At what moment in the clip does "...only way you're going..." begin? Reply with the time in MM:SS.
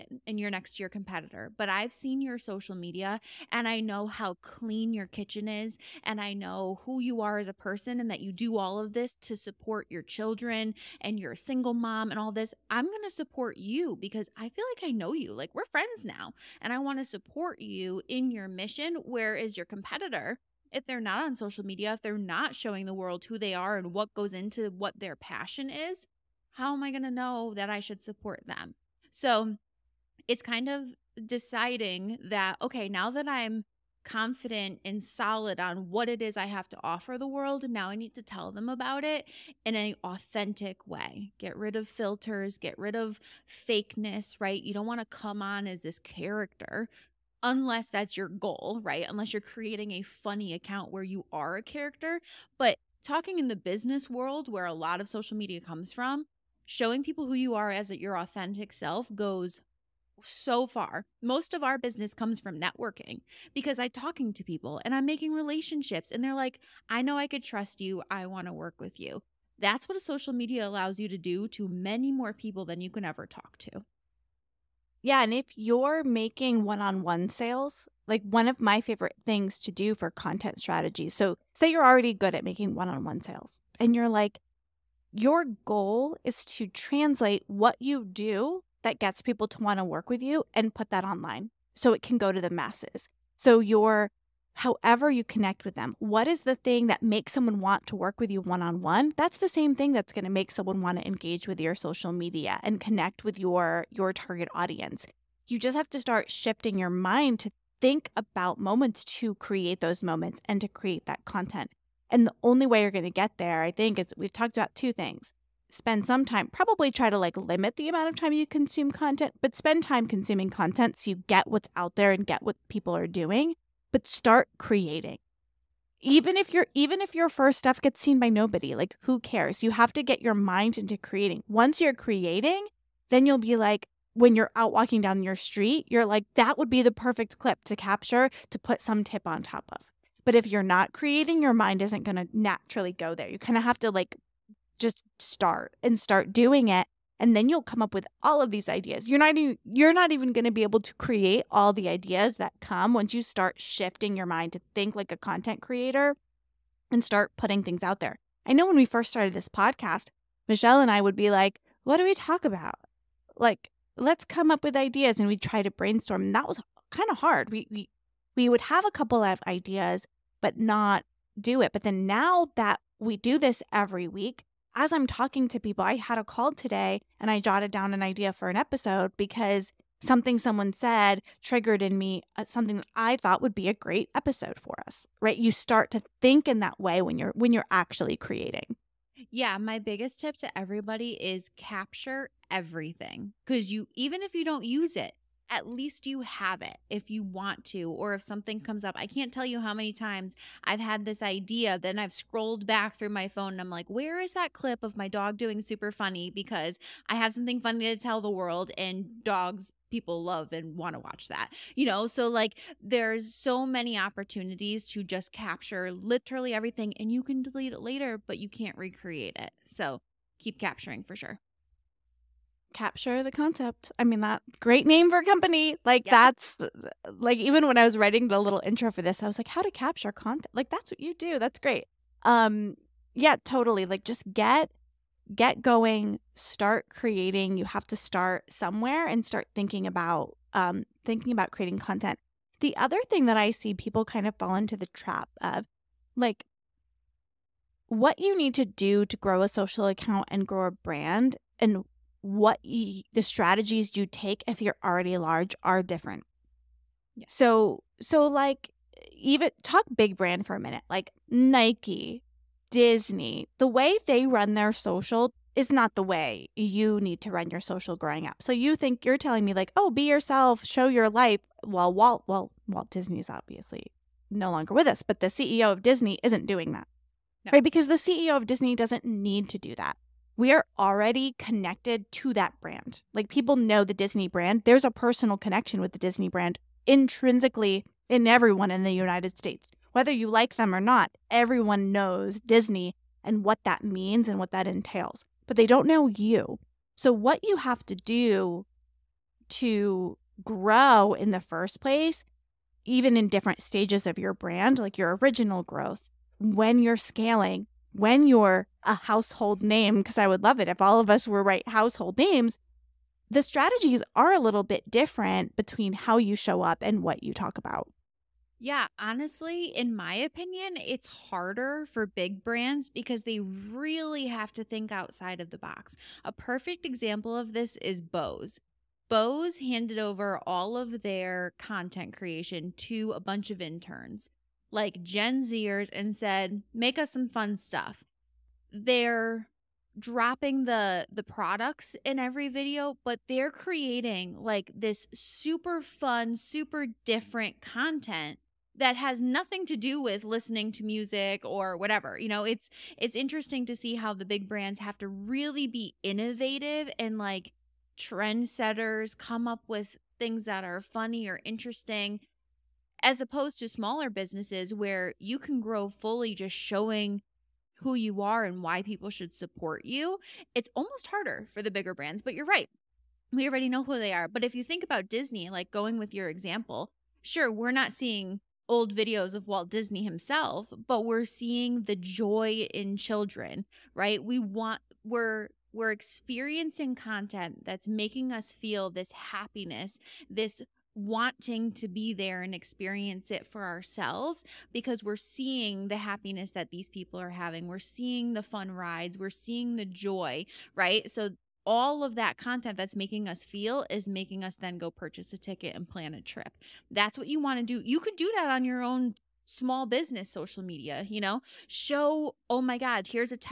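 01:52.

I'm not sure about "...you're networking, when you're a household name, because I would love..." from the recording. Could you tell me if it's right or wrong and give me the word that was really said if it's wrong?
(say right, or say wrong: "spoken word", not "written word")
wrong: "scaling", not "networking".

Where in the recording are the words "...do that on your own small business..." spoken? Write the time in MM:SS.
06:48.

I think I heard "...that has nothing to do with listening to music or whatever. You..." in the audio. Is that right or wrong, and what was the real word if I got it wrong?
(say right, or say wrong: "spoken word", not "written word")
right.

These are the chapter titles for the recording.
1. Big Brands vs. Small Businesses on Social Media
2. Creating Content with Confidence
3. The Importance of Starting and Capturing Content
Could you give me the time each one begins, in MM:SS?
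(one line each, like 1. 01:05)
1. 04:02
2. 00:30
3. 01:52.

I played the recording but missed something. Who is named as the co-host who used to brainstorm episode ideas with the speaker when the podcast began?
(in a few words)
Michelle.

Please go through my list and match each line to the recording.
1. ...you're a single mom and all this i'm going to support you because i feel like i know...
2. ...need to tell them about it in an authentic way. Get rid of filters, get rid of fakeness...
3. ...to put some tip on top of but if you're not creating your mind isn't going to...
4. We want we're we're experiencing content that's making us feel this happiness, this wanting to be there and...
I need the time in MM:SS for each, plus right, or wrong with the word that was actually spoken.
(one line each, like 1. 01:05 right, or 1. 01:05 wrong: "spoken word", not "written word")
1. 00:11 right
2. 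00:37 right
3. 02:18 right
4. 06:24 right.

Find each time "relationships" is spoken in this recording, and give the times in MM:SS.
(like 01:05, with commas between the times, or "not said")
01:05.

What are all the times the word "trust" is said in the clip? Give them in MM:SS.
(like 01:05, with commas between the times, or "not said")
01:07.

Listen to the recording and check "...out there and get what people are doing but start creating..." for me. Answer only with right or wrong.
right.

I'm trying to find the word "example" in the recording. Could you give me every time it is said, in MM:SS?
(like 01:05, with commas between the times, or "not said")
05:26, 06:16.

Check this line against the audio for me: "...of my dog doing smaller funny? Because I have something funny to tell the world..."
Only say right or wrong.
wrong.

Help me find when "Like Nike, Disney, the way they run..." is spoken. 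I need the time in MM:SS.
04:20.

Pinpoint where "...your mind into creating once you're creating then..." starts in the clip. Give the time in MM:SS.
02:10.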